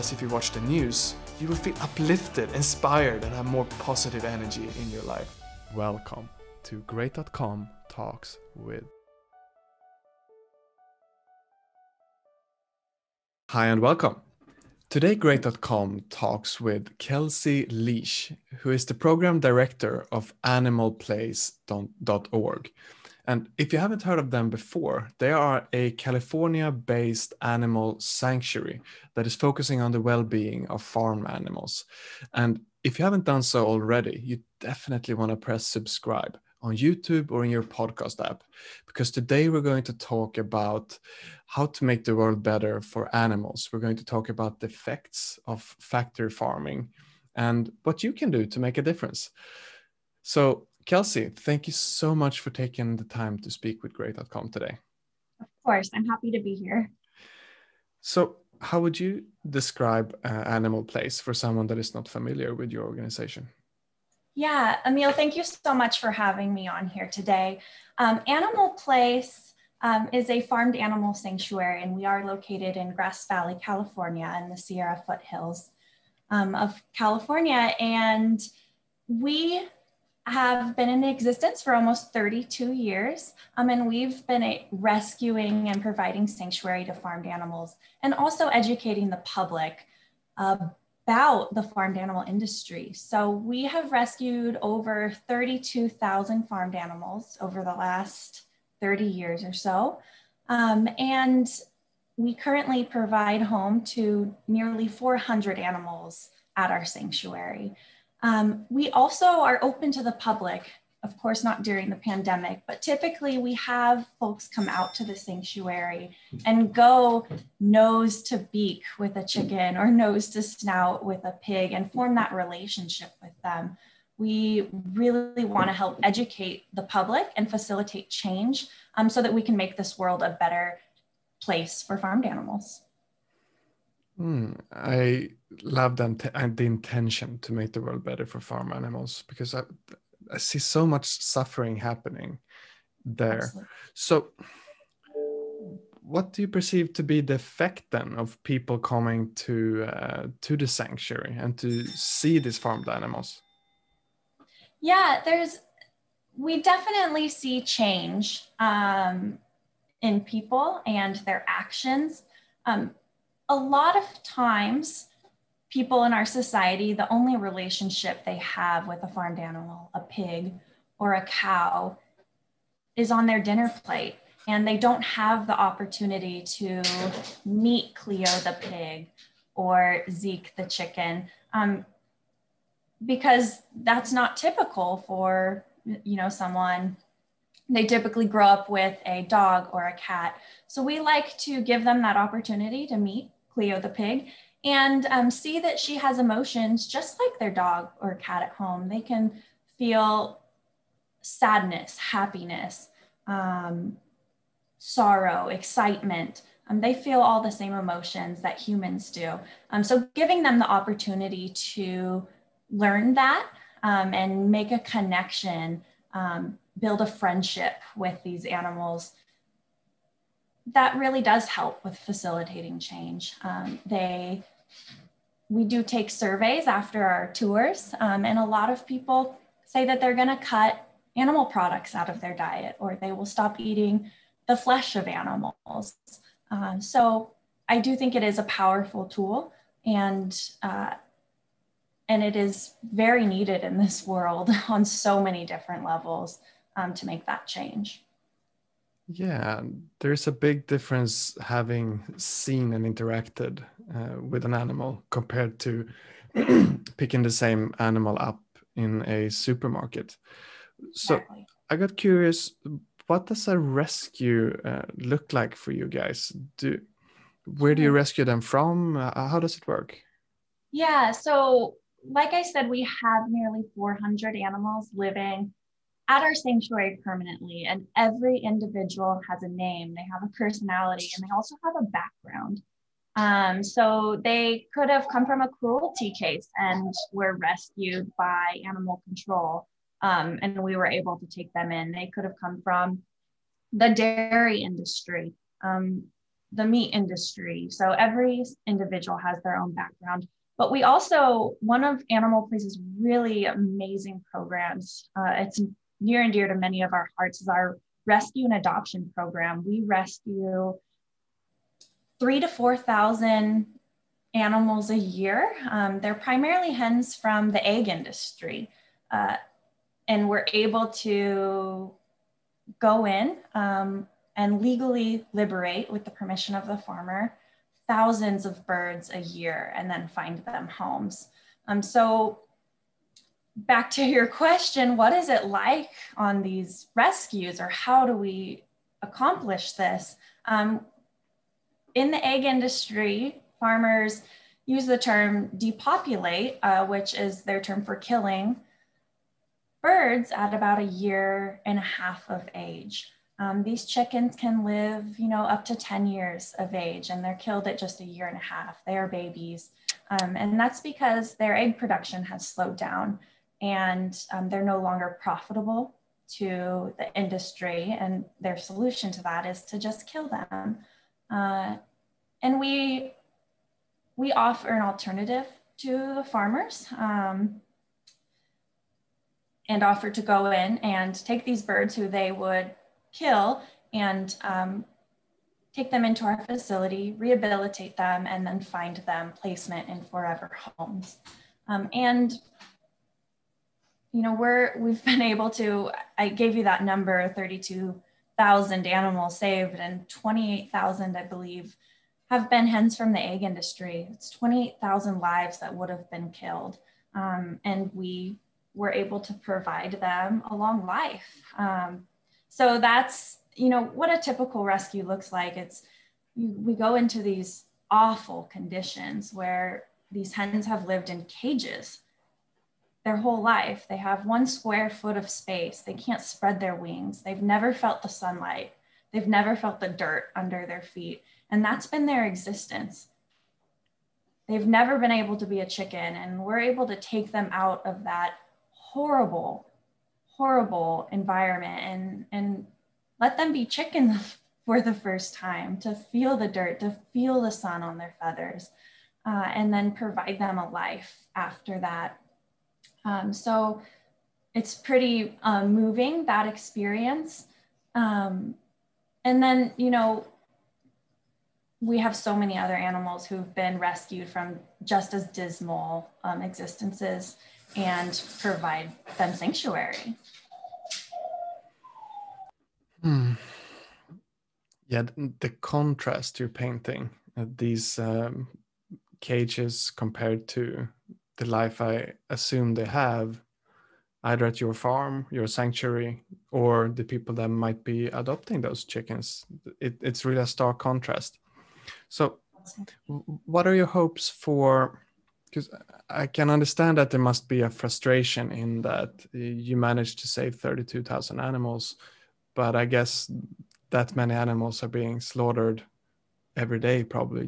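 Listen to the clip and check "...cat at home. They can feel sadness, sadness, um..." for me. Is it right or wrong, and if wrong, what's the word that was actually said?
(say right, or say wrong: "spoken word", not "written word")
wrong: "happiness", not "sadness".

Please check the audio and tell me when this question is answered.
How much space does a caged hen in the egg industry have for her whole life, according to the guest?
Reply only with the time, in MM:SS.
07:04.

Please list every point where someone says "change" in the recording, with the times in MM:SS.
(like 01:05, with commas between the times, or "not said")
02:08, 02:37, 03:42, 04:07.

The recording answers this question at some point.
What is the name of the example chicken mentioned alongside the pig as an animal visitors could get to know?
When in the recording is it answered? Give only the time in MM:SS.
03:00.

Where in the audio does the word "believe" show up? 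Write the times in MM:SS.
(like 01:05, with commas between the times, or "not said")
06:41.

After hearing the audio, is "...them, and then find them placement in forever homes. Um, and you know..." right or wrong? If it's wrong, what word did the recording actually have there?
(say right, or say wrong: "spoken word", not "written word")
right.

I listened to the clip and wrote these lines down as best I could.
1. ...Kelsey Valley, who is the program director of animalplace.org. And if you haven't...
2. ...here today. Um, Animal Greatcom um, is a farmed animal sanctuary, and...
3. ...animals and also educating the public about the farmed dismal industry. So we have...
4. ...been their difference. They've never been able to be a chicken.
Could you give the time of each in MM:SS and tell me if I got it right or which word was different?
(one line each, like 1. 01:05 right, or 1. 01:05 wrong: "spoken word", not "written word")
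1. 00:16 wrong: "Leash", not "Valley"
2. 01:06 wrong: "Place", not "Greatcom"
3. 01:27 wrong: "animal", not "dismal"
4. 07:11 wrong: "existence", not "difference".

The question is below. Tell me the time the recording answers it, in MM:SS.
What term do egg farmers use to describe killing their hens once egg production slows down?
05:45.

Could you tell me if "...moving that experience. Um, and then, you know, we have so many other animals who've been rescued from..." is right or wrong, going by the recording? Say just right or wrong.
right.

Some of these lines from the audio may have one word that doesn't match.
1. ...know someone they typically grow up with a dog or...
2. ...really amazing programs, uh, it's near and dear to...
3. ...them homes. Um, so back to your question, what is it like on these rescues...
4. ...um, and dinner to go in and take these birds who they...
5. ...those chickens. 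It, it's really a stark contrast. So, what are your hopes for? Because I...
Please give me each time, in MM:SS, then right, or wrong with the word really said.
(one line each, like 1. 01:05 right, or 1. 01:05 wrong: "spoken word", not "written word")
1. 03:06 right
2. 05:03 right
3. 05:30 right
4. 06:16 wrong: "offer", not "dinner"
5. 08:08 right.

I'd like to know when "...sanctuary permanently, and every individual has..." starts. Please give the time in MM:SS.
04:36.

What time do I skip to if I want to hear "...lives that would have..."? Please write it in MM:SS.
06:45.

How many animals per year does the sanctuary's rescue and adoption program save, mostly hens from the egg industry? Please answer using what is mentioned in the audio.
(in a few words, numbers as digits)
3,000 to 4,000.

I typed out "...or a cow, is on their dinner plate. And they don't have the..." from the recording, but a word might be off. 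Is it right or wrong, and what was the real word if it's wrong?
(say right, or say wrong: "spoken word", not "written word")
right.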